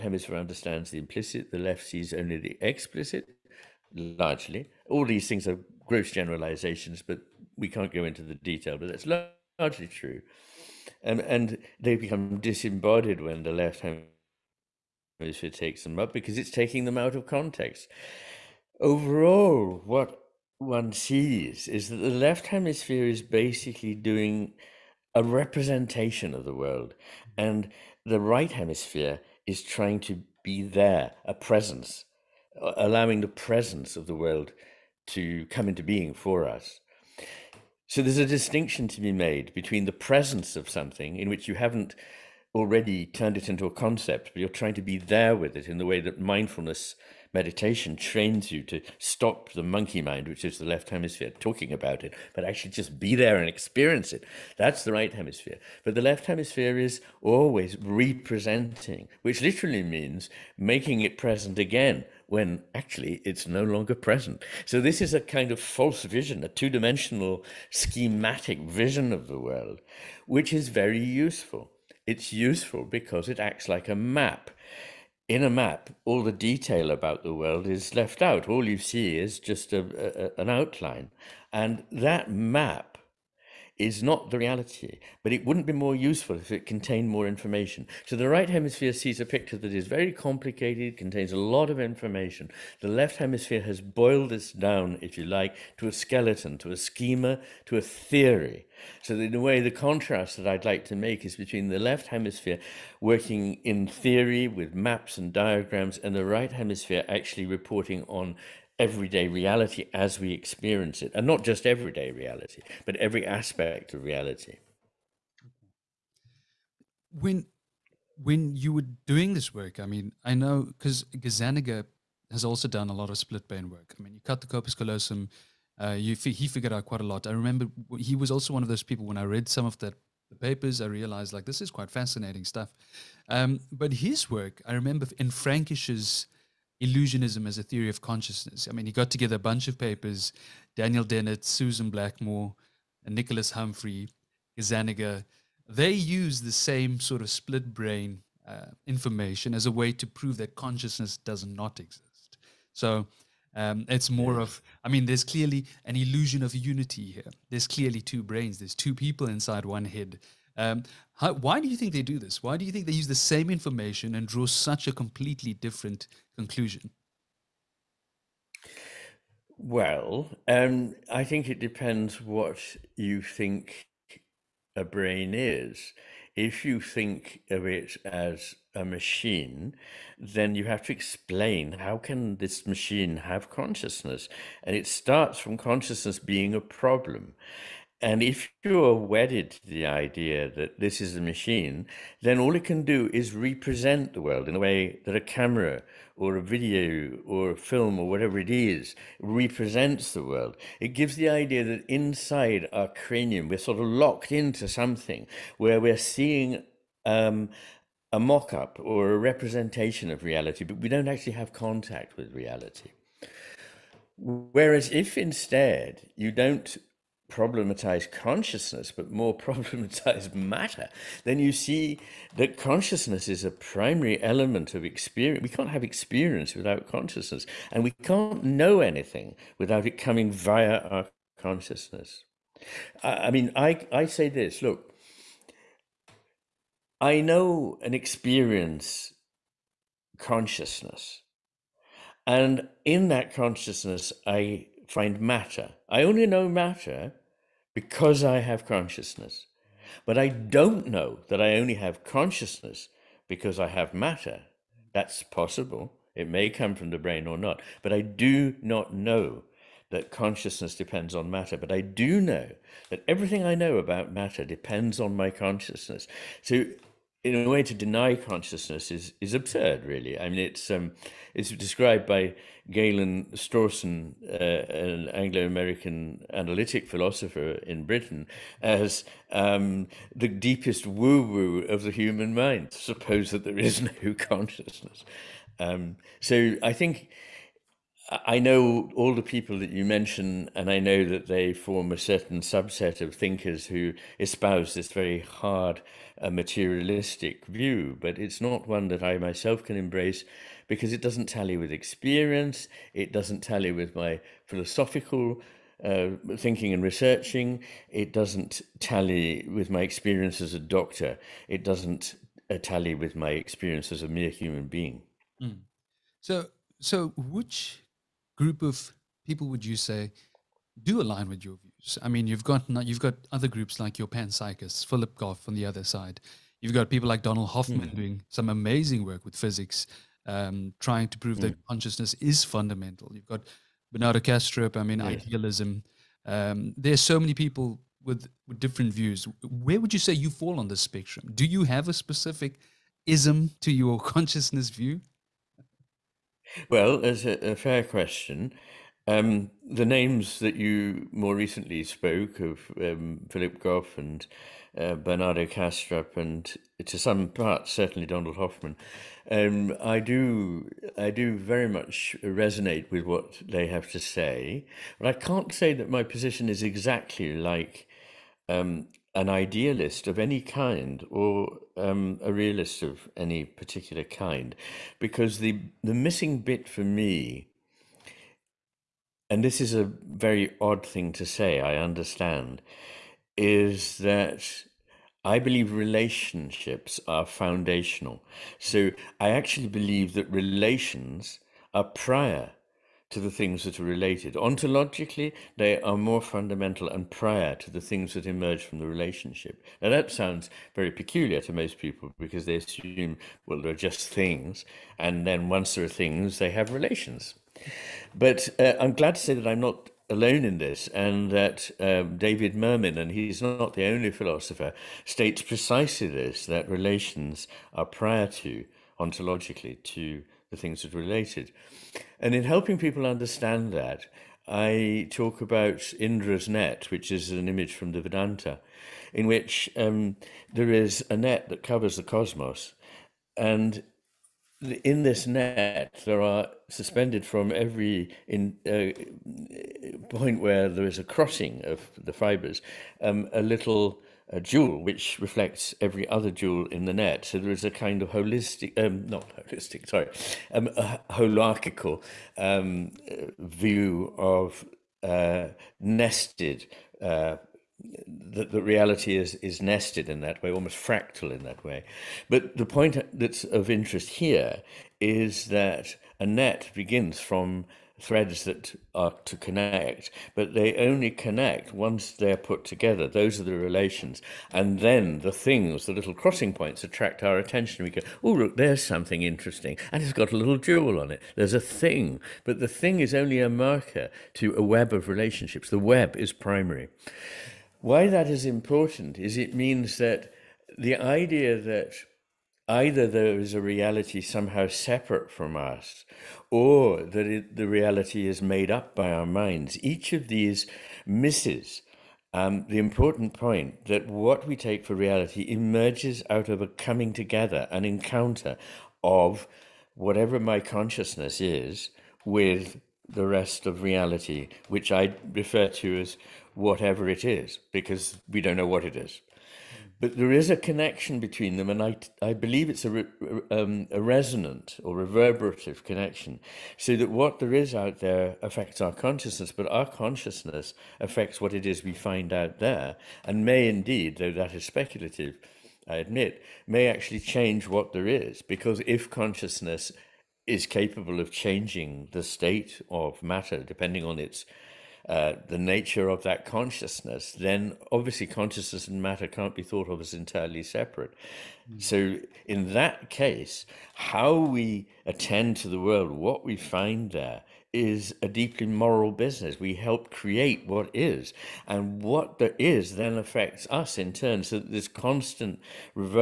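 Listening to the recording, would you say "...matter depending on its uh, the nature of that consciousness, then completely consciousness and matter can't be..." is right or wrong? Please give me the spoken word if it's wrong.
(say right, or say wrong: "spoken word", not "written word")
wrong: "obviously", not "completely".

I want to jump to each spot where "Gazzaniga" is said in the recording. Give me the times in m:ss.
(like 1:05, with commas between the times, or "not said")
2:01, 2:24.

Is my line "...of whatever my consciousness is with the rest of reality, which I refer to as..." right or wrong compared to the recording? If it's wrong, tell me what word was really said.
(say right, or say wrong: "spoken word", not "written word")
right.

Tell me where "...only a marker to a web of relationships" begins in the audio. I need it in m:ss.
8:03.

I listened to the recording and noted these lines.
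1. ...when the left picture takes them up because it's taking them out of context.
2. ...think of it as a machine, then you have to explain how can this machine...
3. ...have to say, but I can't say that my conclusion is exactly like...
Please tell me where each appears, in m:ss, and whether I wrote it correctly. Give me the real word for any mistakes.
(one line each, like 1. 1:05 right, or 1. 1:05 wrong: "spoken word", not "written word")
1. 0:13 wrong: "hemisphere", not "picture"
2. 2:56 right
3. 6:03 wrong: "position", not "conclusion".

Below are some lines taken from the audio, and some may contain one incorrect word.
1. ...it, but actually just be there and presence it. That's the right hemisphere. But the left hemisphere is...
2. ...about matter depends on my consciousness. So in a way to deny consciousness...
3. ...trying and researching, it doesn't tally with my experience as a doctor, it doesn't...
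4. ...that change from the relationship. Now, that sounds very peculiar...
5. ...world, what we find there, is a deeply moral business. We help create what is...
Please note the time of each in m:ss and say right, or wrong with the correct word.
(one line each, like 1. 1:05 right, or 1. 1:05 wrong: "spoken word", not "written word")
1. 0:52 wrong: "experience", not "presence"
2. 4:23 right
3. 5:06 wrong: "thinking", not "trying"
4. 6:38 wrong: "emerge", not "change"
5. 9:15 right.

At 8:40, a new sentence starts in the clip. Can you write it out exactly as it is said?
But there is a connection between them, and I, I believe it's a, re, um, a resonant or reverberative connection.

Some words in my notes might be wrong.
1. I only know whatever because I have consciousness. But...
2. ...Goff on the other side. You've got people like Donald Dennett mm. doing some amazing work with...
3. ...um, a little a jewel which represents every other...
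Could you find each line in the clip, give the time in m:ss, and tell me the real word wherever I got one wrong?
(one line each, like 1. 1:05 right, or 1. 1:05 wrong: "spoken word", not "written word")
1. 4:05 wrong: "matter", not "whatever"
2. 5:25 wrong: "Hoffman", not "Dennett"
3. 7:23 wrong: "reflects", not "represents".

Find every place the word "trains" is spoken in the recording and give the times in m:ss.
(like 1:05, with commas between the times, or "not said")
0:47.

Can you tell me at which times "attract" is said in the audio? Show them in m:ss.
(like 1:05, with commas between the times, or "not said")
7:56.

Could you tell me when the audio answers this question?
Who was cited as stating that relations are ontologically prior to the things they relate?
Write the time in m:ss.
6:52.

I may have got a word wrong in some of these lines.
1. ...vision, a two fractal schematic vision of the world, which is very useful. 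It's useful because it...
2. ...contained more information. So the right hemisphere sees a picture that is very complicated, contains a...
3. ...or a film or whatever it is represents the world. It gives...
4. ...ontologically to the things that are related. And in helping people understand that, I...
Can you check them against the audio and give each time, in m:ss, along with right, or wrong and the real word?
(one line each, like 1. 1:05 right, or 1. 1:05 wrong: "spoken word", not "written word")
1. 1:06 wrong: "dimensional", not "fractal"
2. 1:26 right
3. 3:17 right
4. 6:59 right.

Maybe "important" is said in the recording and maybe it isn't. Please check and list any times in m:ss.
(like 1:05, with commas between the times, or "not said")
8:08, 8:22.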